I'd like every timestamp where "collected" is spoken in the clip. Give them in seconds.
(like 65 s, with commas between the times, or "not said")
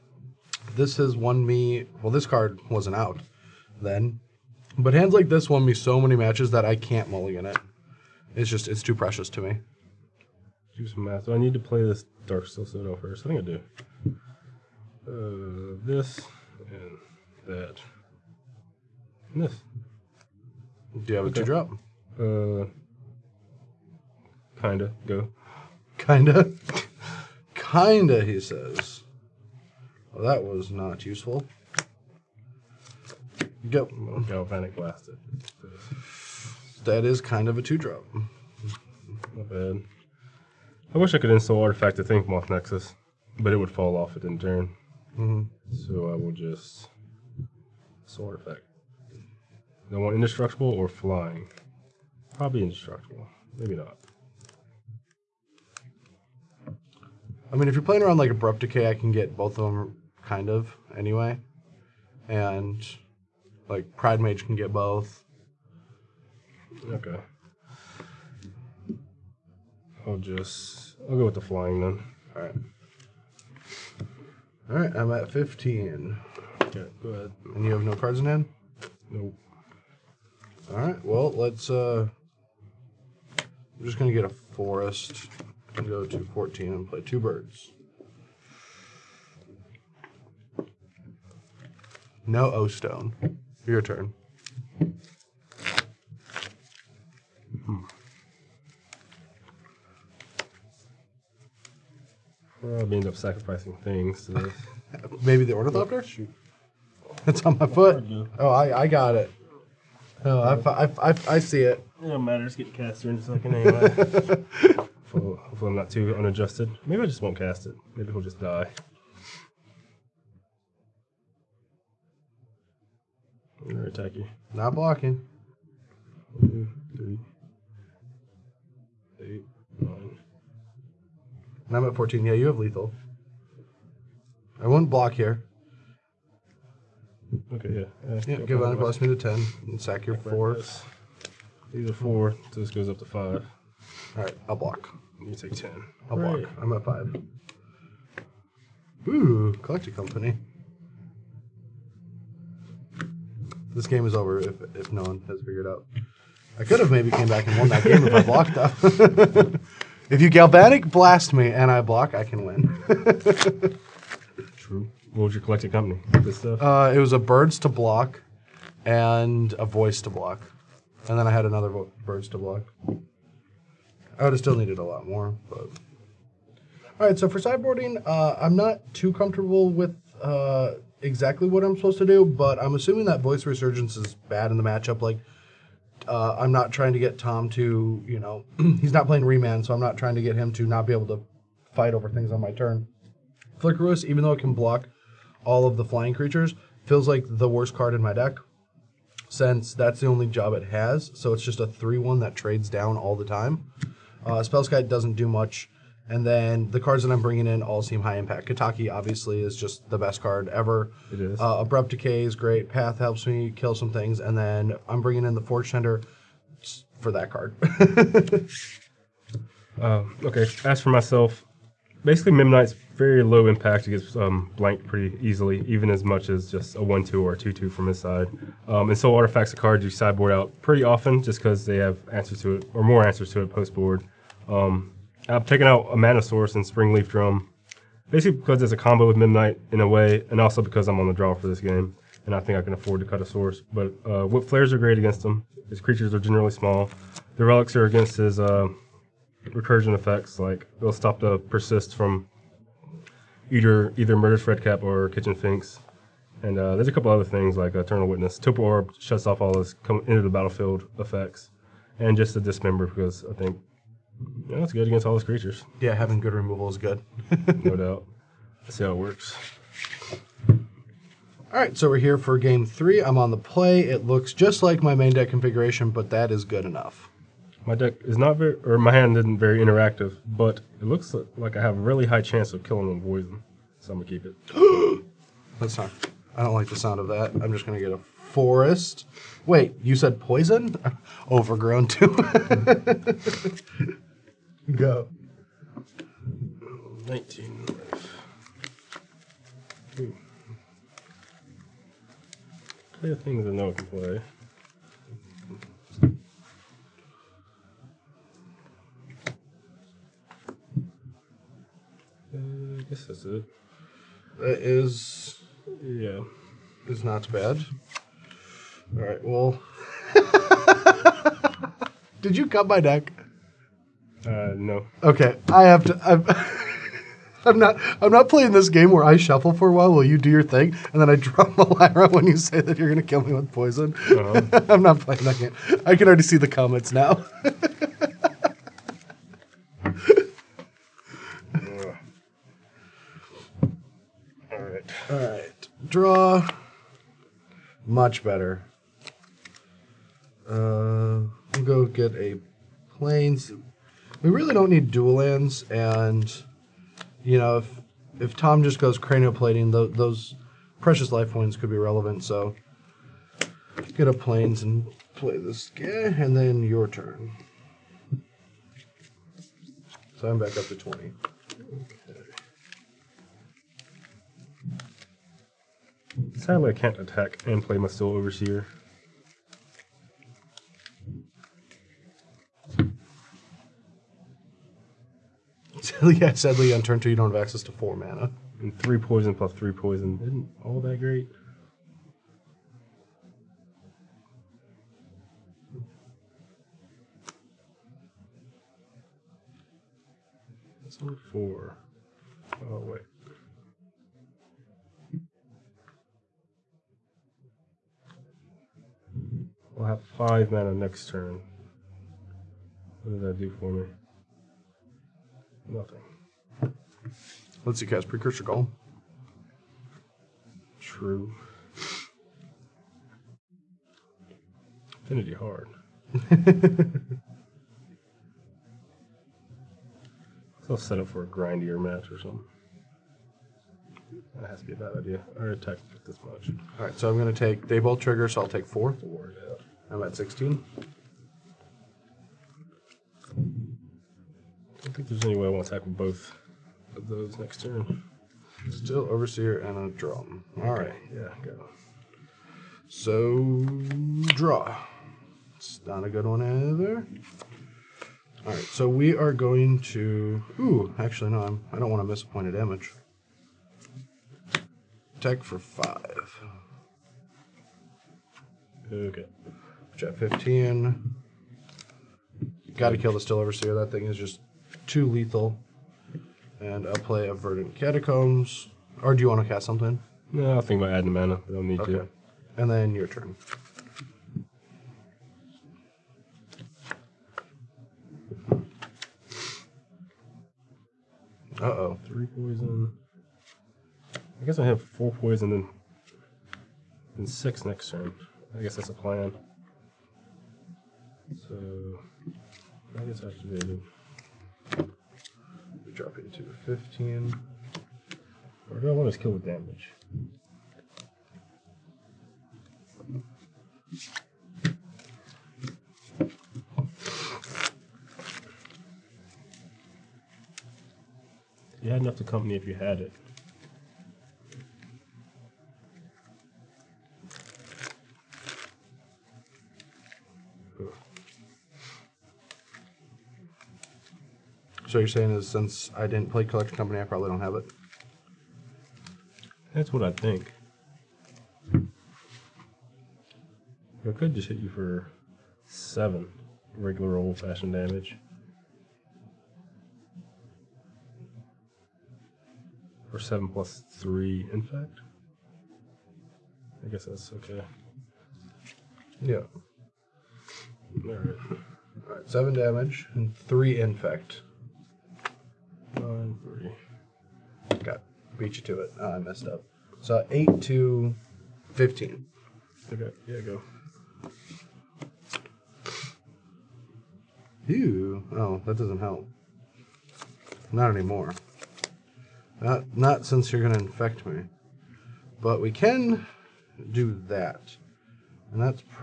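149 s, 165 s, 536 s.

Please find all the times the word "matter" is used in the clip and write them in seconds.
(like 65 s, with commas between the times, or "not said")
112 s.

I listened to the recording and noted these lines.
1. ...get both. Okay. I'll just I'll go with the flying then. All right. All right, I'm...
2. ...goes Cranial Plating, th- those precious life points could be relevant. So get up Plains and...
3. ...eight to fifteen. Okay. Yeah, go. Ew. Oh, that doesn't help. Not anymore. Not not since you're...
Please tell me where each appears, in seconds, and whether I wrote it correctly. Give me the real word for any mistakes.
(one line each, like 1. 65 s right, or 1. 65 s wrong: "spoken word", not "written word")
1. 64 s right
2. 358 s right
3. 570 s right.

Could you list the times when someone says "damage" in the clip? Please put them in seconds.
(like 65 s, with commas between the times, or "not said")
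462 s, 509 s, 547 s, 562 s.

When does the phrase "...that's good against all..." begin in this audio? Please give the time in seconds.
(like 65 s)
264 s.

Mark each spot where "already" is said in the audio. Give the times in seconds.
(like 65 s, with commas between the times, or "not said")
336 s, 435 s.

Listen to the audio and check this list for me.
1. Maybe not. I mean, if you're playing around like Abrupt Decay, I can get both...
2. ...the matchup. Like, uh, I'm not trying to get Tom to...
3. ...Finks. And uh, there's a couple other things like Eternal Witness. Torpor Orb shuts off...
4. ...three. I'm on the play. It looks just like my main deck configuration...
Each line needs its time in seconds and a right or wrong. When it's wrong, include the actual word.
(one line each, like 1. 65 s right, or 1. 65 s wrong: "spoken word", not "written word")
1. 53 s right
2. 184 s right
3. 255 s right
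4. 272 s right.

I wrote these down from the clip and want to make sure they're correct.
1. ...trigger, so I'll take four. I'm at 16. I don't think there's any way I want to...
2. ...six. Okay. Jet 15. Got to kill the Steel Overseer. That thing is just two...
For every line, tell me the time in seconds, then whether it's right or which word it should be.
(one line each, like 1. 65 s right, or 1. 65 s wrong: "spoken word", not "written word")
1. 438 s right
2. 465 s wrong: "five", not "six".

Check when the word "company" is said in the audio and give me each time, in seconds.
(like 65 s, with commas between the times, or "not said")
149 s, 165 s, 522 s, 536 s.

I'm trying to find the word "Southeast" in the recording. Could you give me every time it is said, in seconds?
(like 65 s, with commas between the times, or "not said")
not said.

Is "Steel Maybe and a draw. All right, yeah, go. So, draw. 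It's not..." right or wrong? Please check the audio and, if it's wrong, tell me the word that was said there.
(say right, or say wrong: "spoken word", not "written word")
wrong: "Overseer", not "Maybe".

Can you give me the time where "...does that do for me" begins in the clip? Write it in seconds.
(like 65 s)
413 s.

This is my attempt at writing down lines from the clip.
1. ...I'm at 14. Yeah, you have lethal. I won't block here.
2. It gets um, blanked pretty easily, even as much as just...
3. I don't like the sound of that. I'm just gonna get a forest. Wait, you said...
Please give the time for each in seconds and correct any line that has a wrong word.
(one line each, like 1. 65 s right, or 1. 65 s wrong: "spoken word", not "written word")
1. 131 s right
2. 223 s right
3. 286 s right.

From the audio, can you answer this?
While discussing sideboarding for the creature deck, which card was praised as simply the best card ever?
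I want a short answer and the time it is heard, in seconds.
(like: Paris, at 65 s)
Kataki, at 208 s.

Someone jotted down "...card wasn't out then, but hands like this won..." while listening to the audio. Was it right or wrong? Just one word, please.
right.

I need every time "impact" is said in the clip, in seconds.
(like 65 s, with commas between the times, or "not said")
208 s, 223 s.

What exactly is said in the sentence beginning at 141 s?
These are four, so this goes up to five.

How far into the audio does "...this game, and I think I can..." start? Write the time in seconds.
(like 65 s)
241 s.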